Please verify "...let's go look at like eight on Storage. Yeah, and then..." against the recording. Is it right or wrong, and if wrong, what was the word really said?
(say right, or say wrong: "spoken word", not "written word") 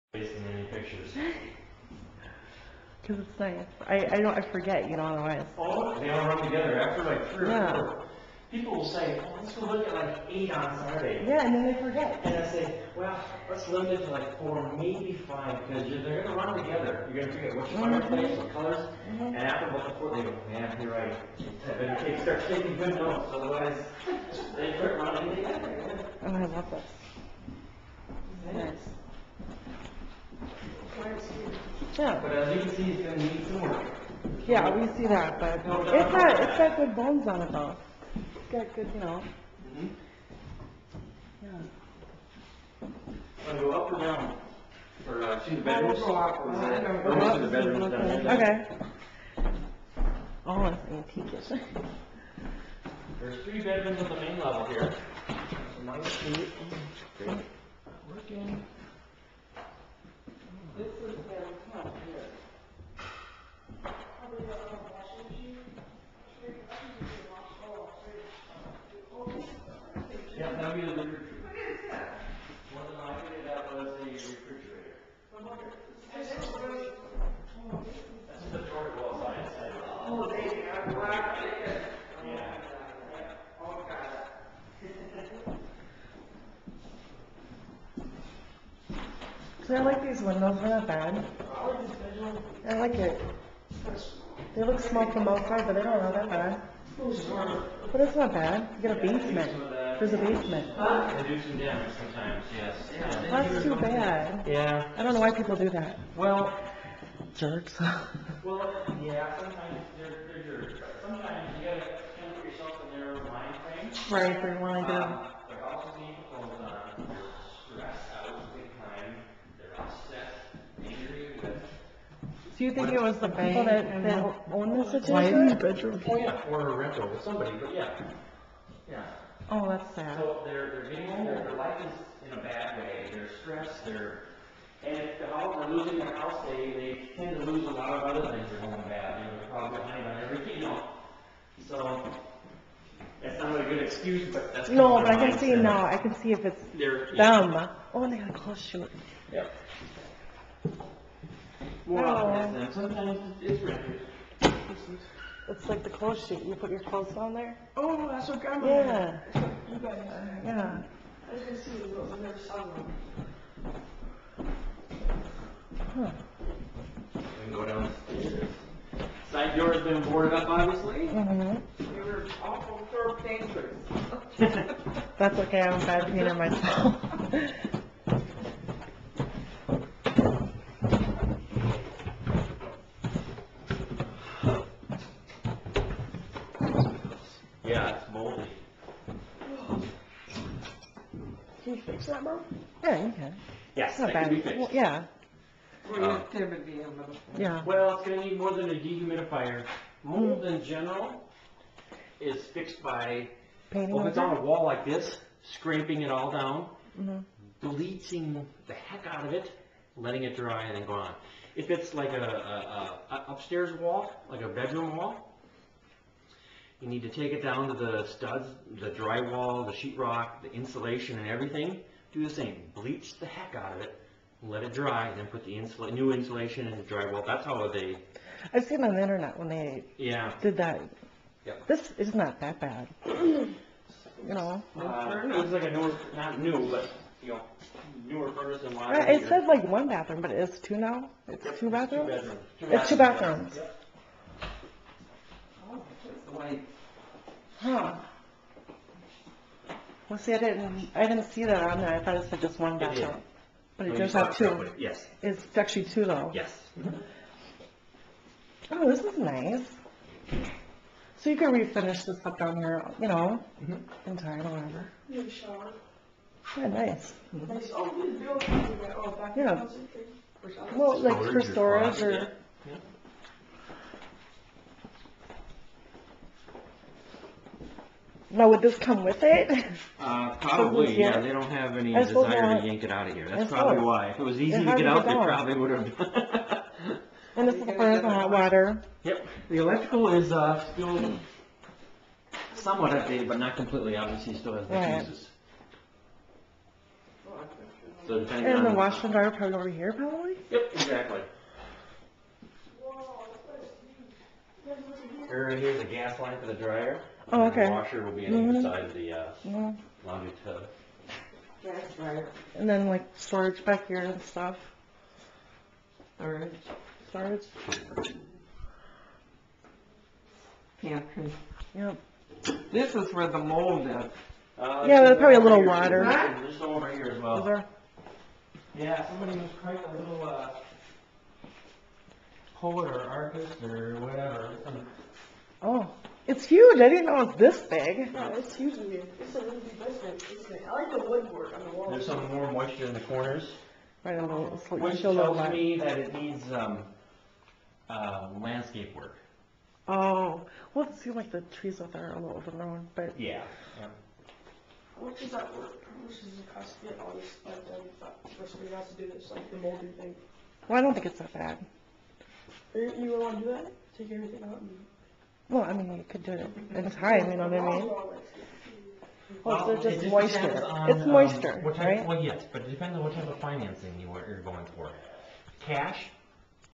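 wrong: "Saturday", not "Storage".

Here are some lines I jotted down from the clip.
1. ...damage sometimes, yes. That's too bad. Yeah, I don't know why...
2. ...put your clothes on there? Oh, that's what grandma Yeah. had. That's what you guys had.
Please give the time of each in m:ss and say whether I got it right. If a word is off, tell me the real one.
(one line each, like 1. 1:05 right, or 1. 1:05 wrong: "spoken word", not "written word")
1. 1:41 right
2. 2:36 right.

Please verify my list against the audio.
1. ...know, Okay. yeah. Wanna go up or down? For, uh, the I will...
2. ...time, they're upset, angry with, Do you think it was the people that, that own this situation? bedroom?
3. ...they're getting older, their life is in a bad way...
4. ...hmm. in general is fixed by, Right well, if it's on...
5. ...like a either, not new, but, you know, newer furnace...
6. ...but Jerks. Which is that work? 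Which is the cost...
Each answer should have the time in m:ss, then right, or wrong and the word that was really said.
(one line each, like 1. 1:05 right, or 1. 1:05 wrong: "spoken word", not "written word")
1. 0:39 wrong: "Mhm", not "Okay"
2. 1:58 right
3. 2:10 right
4. 3:20 wrong: "Painting", not "Right"
5. 3:55 wrong: "newer", not "either"
6. 5:52 wrong: "Yeah", not "Jerks".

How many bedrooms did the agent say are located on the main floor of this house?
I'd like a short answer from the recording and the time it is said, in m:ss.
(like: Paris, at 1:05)
3, at 0:53.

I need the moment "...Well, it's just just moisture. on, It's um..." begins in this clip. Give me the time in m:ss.
6:09.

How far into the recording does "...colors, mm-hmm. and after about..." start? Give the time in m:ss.
0:18.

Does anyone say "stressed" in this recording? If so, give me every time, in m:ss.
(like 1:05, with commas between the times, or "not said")
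1:57, 2:13.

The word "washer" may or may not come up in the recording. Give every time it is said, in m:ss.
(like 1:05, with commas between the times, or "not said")
4:58, 5:07.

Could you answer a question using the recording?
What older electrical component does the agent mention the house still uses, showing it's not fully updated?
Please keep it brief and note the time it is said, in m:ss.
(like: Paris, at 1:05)
Fuses, at 4:55.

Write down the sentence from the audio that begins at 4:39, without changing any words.
Uh, probably, yeah, they don't have any I desire to yank it out of here, that's probably why.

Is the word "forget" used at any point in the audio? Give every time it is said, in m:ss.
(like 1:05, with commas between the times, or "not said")
0:04, 0:11.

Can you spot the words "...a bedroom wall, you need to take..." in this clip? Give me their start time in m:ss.
3:34.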